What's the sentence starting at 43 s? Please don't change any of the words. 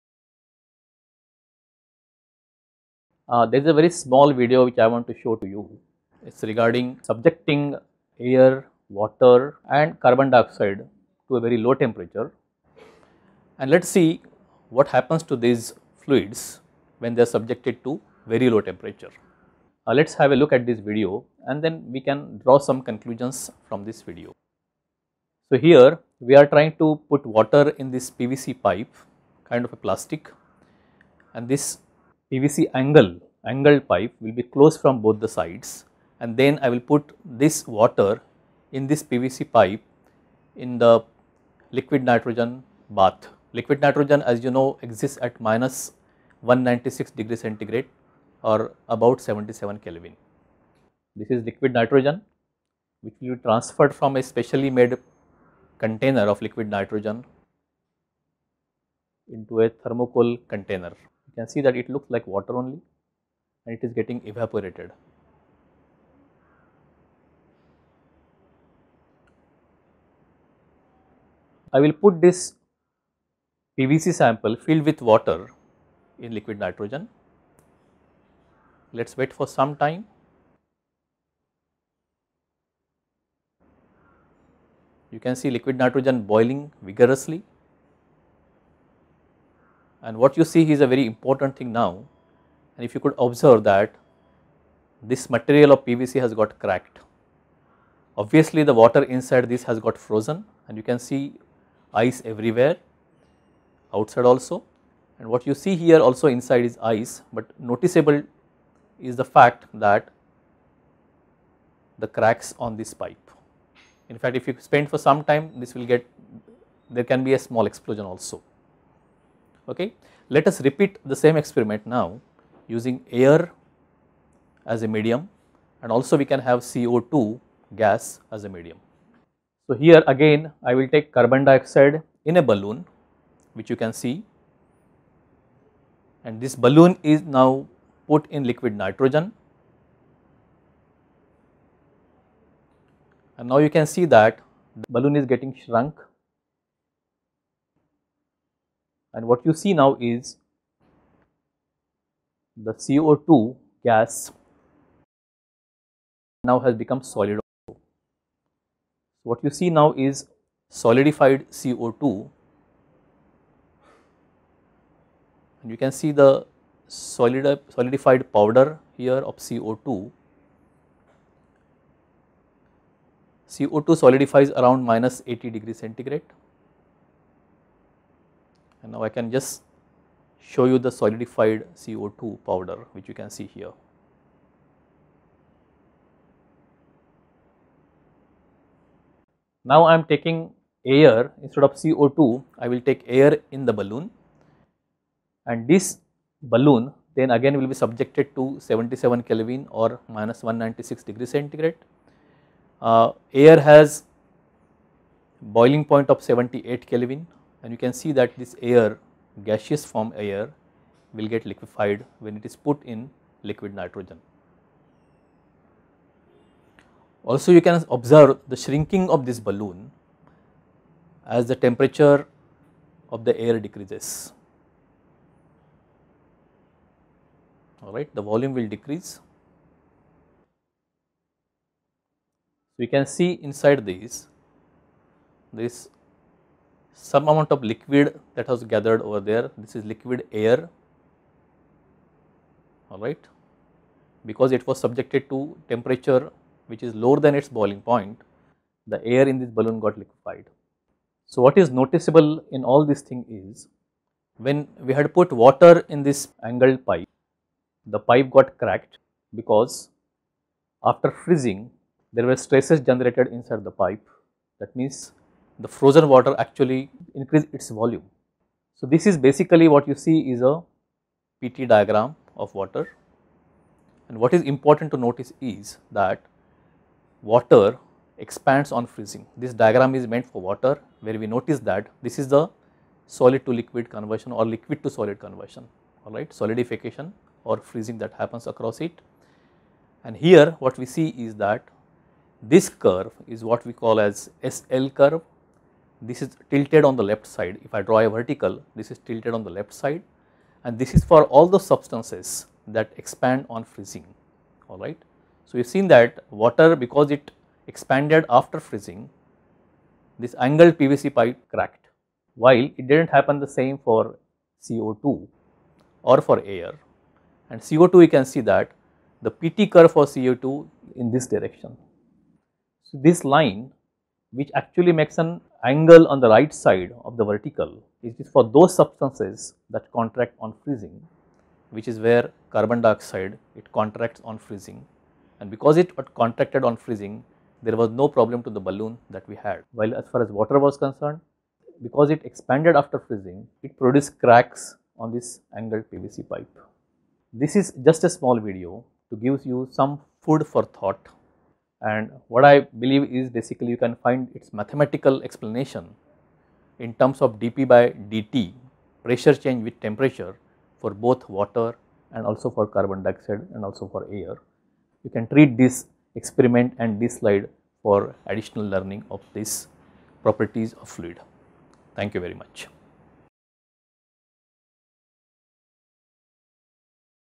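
Liquid nitrogen as you know exists at minus 196 degree centigrade or about 77 Kelvin.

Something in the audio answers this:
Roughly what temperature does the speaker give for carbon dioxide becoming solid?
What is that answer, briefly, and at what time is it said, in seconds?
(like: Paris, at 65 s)
-80 degrees Celsius, at 174 s.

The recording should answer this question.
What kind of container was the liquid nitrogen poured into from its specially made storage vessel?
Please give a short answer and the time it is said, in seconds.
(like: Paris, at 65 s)
thermocol container, at 59 s.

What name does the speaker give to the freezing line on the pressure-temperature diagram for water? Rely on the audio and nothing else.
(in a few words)
SL curve.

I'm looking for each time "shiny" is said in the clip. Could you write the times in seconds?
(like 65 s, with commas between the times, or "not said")
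not said.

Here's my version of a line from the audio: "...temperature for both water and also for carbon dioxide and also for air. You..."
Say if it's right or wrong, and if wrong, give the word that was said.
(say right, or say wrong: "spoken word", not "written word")
right.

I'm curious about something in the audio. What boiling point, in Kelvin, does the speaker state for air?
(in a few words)
78 K.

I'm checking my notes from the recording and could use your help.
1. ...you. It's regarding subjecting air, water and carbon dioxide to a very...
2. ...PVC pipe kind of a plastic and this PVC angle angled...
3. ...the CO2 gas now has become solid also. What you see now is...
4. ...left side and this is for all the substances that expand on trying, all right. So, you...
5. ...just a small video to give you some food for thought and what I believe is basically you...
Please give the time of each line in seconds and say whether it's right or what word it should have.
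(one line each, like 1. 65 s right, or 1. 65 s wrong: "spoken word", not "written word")
1. 5 s right
2. 28 s right
3. 152 s right
4. 299 s wrong: "freezing", not "trying"
5. 347 s right.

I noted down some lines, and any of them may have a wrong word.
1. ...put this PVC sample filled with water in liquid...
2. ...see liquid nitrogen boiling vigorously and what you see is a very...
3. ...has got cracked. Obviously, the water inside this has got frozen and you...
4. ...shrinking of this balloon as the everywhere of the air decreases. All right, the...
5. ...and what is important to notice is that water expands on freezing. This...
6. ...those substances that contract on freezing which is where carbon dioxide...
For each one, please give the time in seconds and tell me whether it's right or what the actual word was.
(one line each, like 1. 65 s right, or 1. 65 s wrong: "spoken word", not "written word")
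1. 71 s right
2. 85 s right
3. 96 s right
4. 218 s wrong: "temperature", not "everywhere"
5. 274 s right
6. 328 s right.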